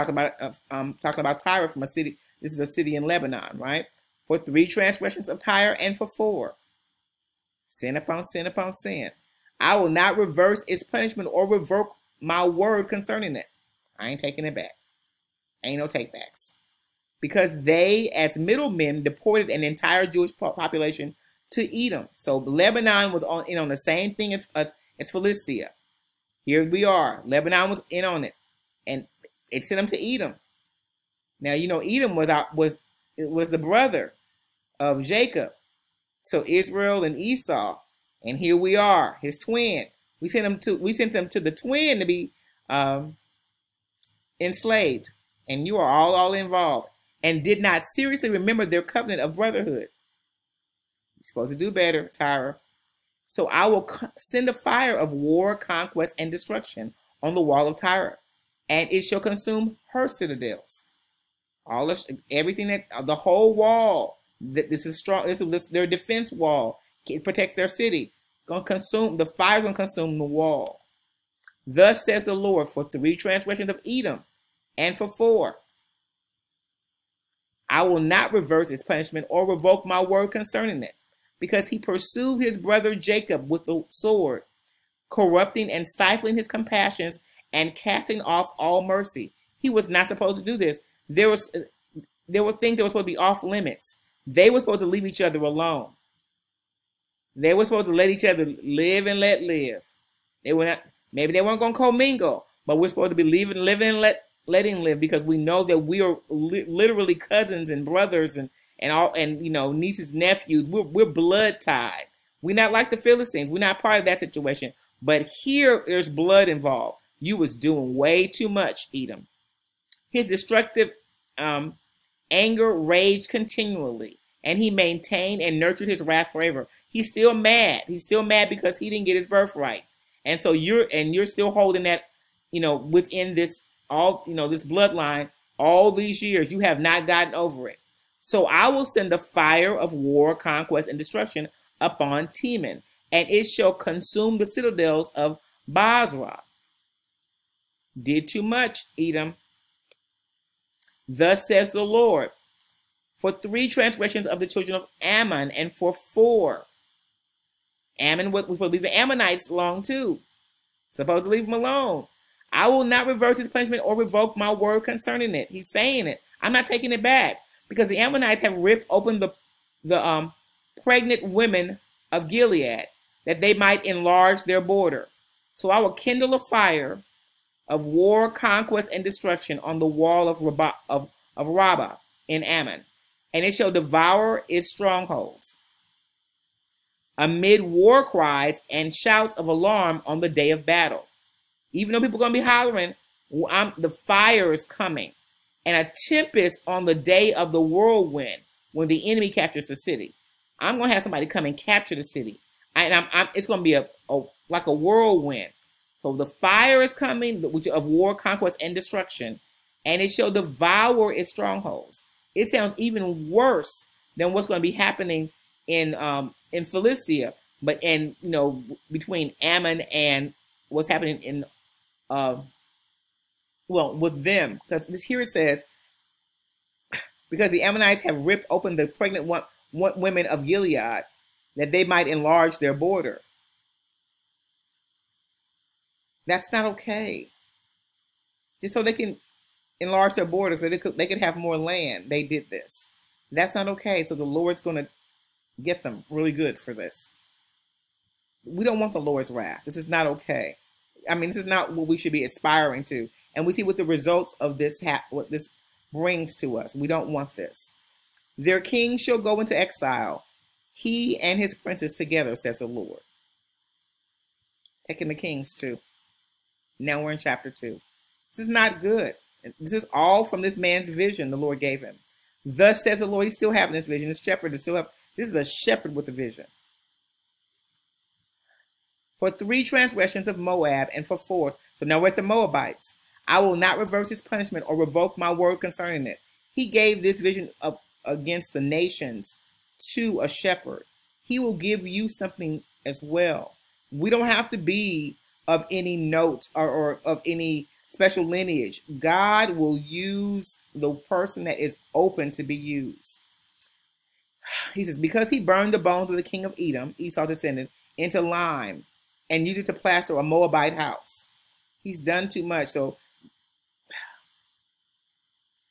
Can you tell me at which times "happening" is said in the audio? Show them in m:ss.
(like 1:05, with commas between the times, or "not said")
3:34, 3:40.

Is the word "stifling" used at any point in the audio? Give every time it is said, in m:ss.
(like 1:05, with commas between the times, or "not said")
1:25.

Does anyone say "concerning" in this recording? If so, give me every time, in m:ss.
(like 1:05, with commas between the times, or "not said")
0:12, 1:20, 2:44, 4:45.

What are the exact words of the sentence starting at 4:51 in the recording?
He will give you something as well.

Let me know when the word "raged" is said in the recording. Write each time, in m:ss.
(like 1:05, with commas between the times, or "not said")
2:02.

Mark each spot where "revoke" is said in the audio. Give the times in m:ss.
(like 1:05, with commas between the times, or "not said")
0:11, 1:19, 2:43, 4:44.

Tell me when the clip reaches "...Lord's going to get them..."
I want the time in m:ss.
4:04.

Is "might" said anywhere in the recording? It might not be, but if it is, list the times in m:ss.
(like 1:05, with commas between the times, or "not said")
2:53, 3:51.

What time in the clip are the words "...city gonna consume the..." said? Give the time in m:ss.
1:07.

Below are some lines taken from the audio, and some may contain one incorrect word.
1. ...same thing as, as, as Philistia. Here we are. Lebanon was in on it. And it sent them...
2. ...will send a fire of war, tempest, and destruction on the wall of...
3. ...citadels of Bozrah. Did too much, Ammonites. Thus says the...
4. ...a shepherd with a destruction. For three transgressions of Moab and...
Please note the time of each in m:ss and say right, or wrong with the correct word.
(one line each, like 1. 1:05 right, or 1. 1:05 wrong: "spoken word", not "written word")
1. 0:23 right
2. 0:53 wrong: "conquest", not "tempest"
3. 2:24 wrong: "Edom", not "Ammonites"
4. 4:35 wrong: "vision", not "destruction".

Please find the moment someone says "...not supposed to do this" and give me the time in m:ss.
1:29.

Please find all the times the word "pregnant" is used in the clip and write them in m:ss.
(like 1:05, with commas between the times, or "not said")
2:50, 3:48.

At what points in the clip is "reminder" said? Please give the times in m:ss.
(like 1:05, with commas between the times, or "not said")
not said.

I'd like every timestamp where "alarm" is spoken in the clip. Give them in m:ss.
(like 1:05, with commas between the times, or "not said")
3:09.